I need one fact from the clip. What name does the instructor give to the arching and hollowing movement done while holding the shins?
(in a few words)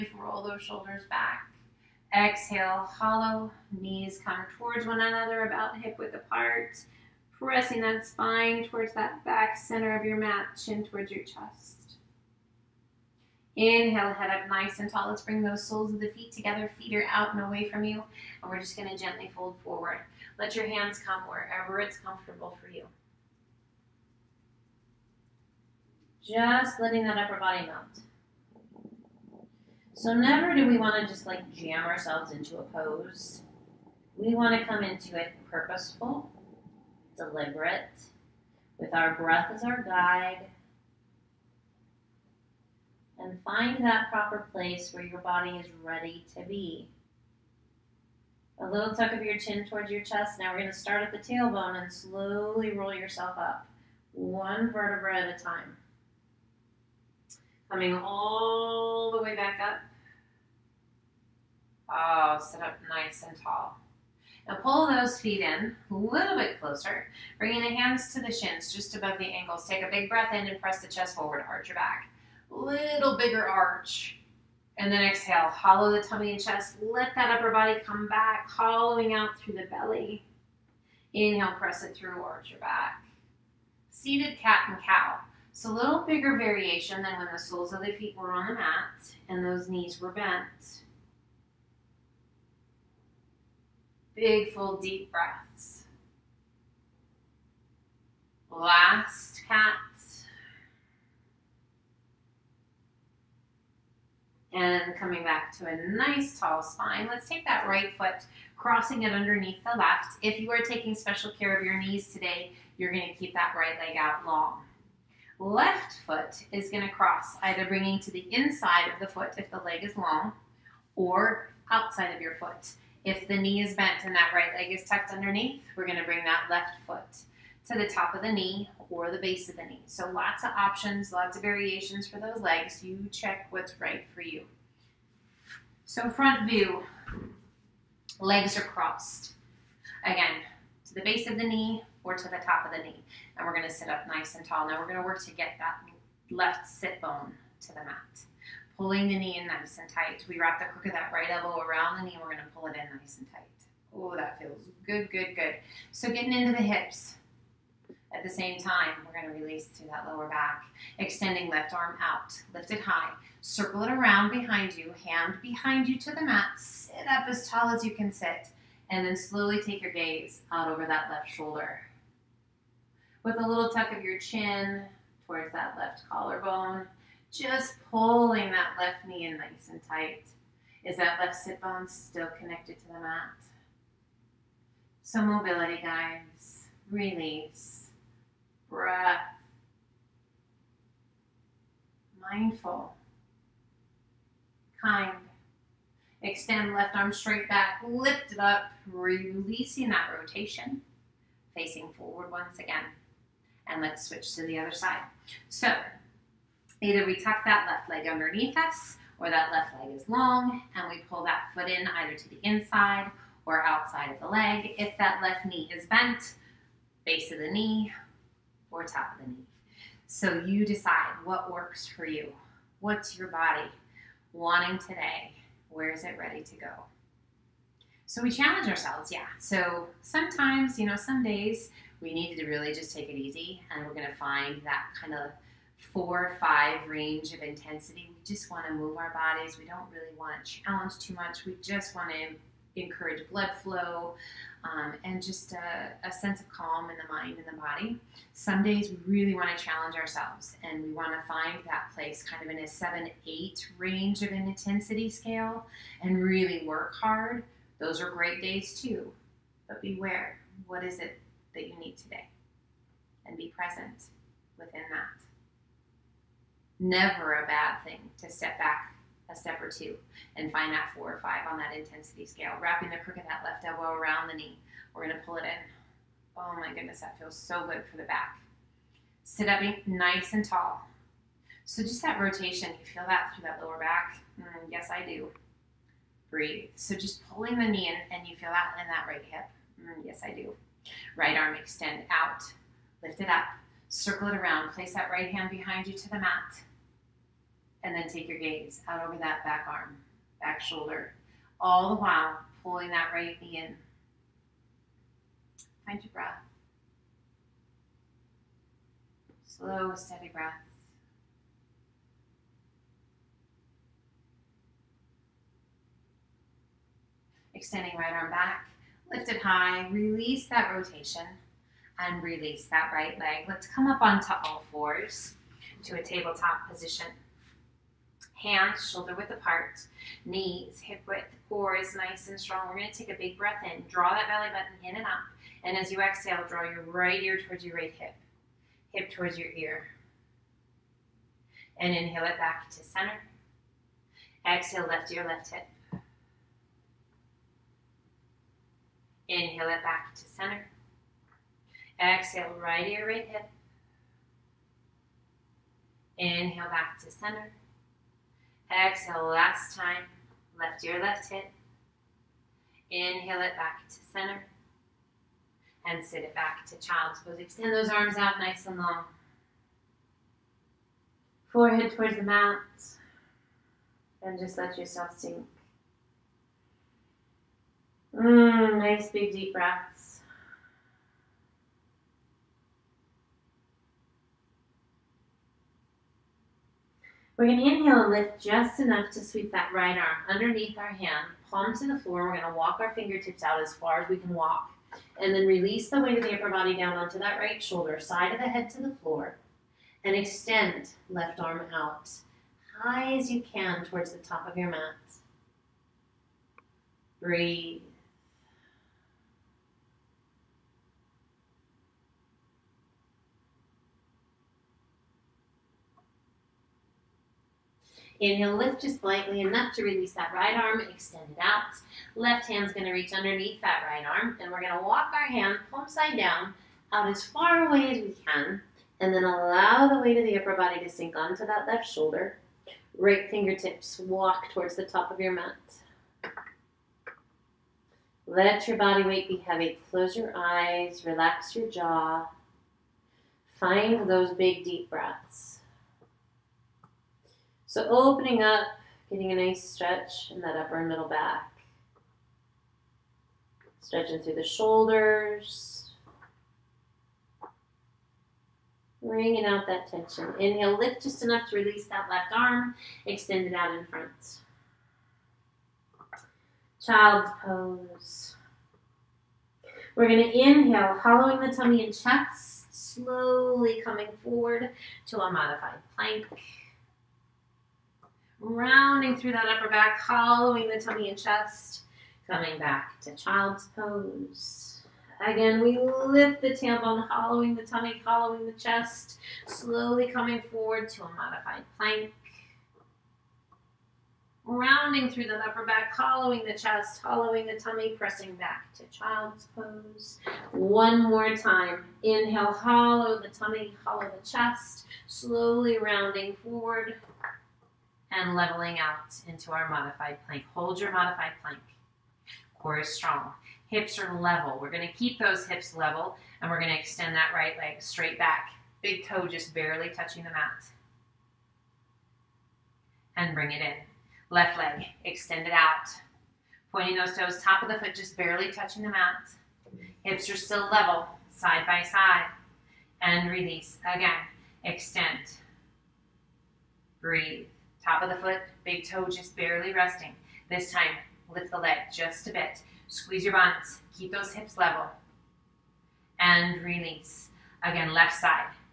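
Seated cat and cow.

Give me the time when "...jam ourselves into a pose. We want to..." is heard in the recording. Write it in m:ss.
0:31.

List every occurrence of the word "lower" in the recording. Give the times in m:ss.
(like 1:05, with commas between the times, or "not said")
2:40, 4:43.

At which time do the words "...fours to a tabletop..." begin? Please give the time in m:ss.
5:24.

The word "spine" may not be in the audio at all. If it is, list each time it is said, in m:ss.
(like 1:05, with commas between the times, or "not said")
0:08, 1:46.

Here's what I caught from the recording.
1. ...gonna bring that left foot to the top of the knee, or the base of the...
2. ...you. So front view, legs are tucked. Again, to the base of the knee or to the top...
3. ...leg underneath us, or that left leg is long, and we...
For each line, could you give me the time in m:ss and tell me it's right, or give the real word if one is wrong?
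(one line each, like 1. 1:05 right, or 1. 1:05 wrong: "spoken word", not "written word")
1. 2:05 right
2. 2:14 wrong: "crossed", not "tucked"
3. 3:27 right.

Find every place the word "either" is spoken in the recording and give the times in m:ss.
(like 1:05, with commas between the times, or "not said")
1:57, 3:26, 3:31.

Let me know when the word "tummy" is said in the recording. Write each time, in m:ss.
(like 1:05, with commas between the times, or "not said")
1:16, 7:51, 8:00, 8:07, 8:17, 8:23.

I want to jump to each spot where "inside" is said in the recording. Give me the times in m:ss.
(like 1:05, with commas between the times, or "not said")
1:58, 3:32.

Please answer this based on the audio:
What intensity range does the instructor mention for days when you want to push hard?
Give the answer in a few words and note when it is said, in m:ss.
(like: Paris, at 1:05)
7 8, at 4:12.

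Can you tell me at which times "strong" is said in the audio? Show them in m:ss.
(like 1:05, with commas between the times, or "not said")
5:32, 8:32.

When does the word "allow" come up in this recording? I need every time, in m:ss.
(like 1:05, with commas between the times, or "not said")
7:09.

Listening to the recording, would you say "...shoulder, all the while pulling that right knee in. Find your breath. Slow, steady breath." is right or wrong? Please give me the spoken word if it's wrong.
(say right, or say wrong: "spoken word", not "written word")
right.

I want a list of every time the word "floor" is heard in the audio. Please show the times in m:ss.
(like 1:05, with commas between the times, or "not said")
6:31, 6:39.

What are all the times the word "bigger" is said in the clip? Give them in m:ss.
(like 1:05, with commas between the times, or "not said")
1:13, 1:25.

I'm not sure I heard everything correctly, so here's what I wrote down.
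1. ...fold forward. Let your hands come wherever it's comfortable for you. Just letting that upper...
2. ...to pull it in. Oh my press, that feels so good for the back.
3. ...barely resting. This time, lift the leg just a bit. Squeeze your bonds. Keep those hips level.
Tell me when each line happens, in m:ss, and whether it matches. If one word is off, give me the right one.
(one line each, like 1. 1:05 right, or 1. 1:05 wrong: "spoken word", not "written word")
1. 0:19 right
2. 4:35 wrong: "goodness", not "press"
3. 8:59 right.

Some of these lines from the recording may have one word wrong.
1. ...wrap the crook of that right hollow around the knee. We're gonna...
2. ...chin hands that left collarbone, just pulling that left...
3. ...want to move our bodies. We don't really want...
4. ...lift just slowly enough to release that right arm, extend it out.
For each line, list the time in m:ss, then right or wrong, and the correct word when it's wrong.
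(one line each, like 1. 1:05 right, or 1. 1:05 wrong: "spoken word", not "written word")
1. 2:30 wrong: "elbow", not "hollow"
2. 2:54 wrong: "towards", not "hands"
3. 3:58 right
4. 6:58 wrong: "slightly", not "slowly".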